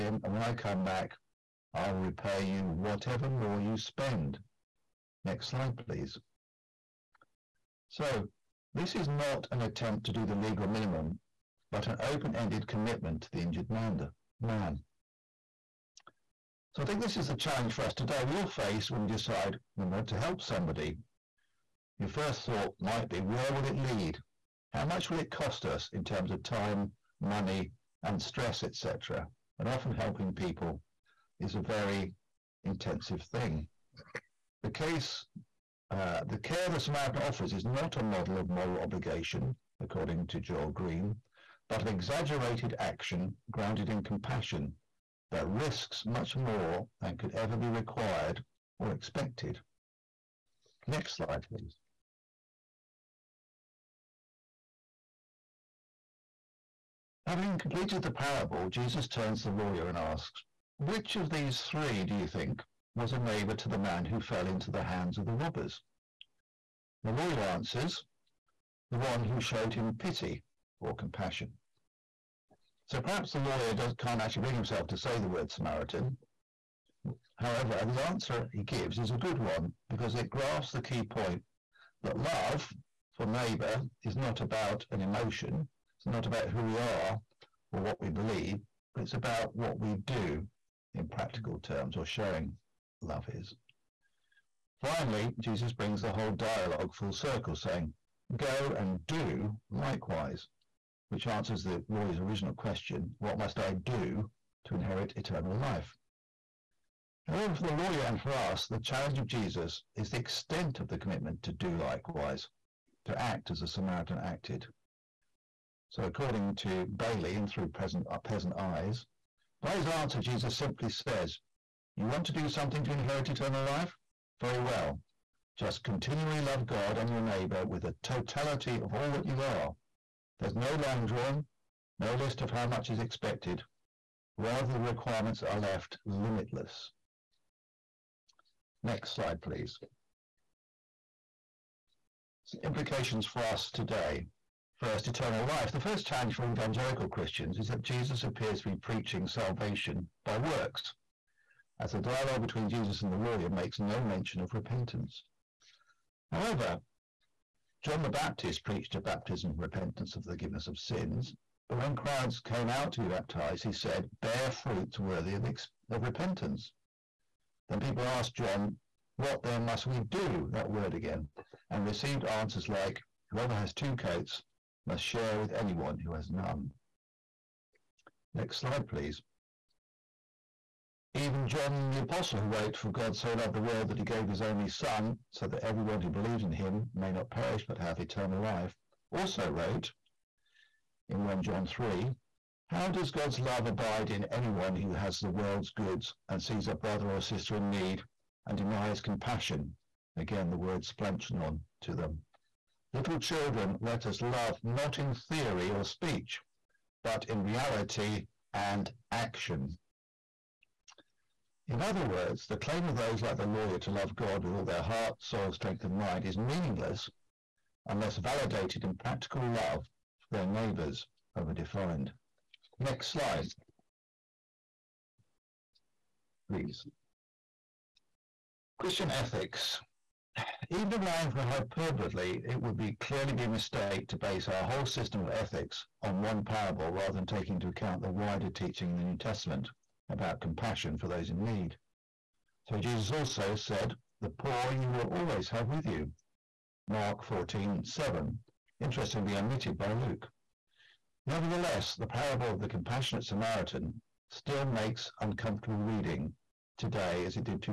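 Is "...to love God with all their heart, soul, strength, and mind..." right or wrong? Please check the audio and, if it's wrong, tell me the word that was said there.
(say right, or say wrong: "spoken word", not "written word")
right.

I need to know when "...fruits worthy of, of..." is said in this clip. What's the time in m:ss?
2:44.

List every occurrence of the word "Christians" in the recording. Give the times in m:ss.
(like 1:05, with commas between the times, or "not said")
2:27, 3:48.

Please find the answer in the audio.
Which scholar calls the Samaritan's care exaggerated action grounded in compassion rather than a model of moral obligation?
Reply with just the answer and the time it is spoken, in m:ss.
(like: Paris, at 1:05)
Joel Green, at 0:40.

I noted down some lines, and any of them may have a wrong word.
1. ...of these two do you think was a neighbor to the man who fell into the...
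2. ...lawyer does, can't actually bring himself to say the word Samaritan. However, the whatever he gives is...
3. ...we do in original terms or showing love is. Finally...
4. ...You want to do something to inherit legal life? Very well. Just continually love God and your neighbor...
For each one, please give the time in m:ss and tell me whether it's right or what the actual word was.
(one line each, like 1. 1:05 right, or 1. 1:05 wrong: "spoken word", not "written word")
1. 1:01 wrong: "three", not "two"
2. 1:13 wrong: "answer", not "whatever"
3. 1:29 wrong: "practical", not "original"
4. 2:01 wrong: "eternal", not "legal".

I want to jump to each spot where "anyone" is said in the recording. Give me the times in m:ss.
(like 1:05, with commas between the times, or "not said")
2:55, 3:14.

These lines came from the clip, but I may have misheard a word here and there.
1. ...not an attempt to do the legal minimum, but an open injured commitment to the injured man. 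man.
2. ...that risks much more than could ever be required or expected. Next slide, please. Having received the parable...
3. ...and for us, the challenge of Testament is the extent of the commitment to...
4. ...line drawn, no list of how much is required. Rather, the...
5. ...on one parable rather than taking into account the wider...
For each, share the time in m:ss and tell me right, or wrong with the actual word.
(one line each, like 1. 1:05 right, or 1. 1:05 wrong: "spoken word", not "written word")
1. 0:09 wrong: "ended", not "injured"
2. 0:45 wrong: "completed", not "received"
3. 1:48 wrong: "Jesus", not "Testament"
4. 2:10 wrong: "expected", not "required"
5. 3:56 right.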